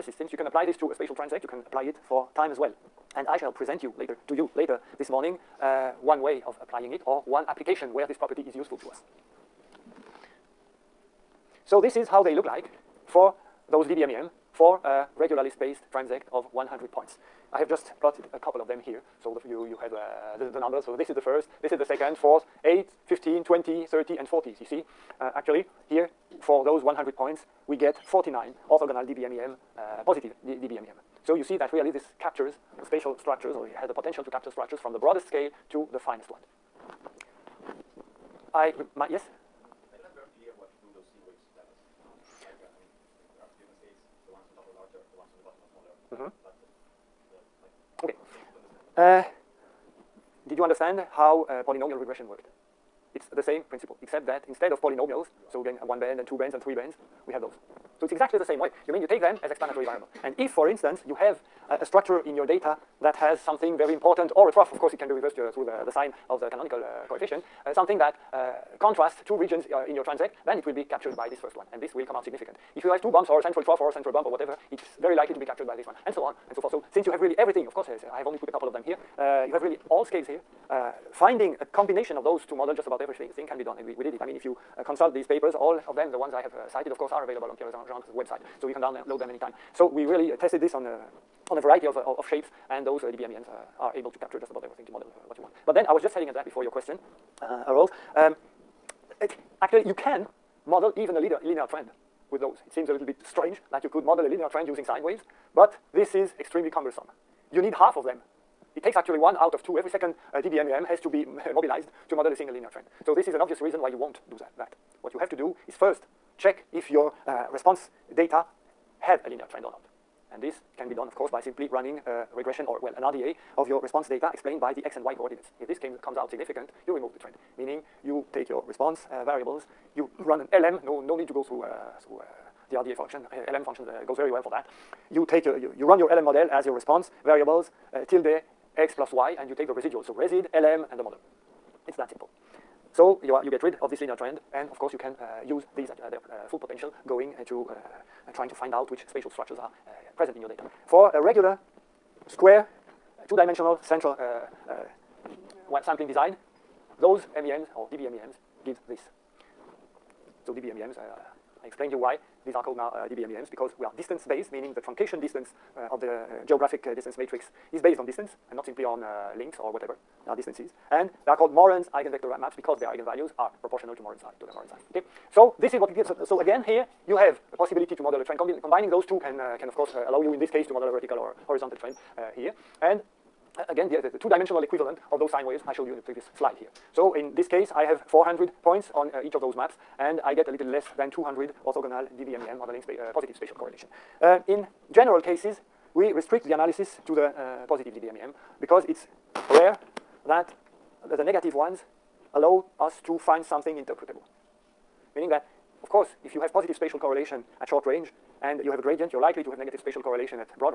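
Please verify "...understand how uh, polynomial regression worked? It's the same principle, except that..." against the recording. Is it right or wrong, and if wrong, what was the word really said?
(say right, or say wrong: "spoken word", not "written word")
right.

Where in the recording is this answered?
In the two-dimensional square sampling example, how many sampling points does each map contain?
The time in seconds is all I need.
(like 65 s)
188 s.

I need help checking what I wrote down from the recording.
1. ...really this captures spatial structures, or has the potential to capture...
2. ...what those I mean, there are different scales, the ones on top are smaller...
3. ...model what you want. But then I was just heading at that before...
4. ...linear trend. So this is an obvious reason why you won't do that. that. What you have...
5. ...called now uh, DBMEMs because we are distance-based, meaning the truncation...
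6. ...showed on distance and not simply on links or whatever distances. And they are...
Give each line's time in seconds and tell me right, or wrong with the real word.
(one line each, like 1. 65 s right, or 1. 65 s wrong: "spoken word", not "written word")
1. 31 s right
2. 40 s wrong: "larger", not "smaller"
3. 94 s right
4. 112 s right
5. 162 s right
6. 167 s wrong: "based", not "showed".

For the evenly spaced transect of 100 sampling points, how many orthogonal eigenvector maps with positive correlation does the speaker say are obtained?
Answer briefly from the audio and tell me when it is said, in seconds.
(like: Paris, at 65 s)
49, at 28 s.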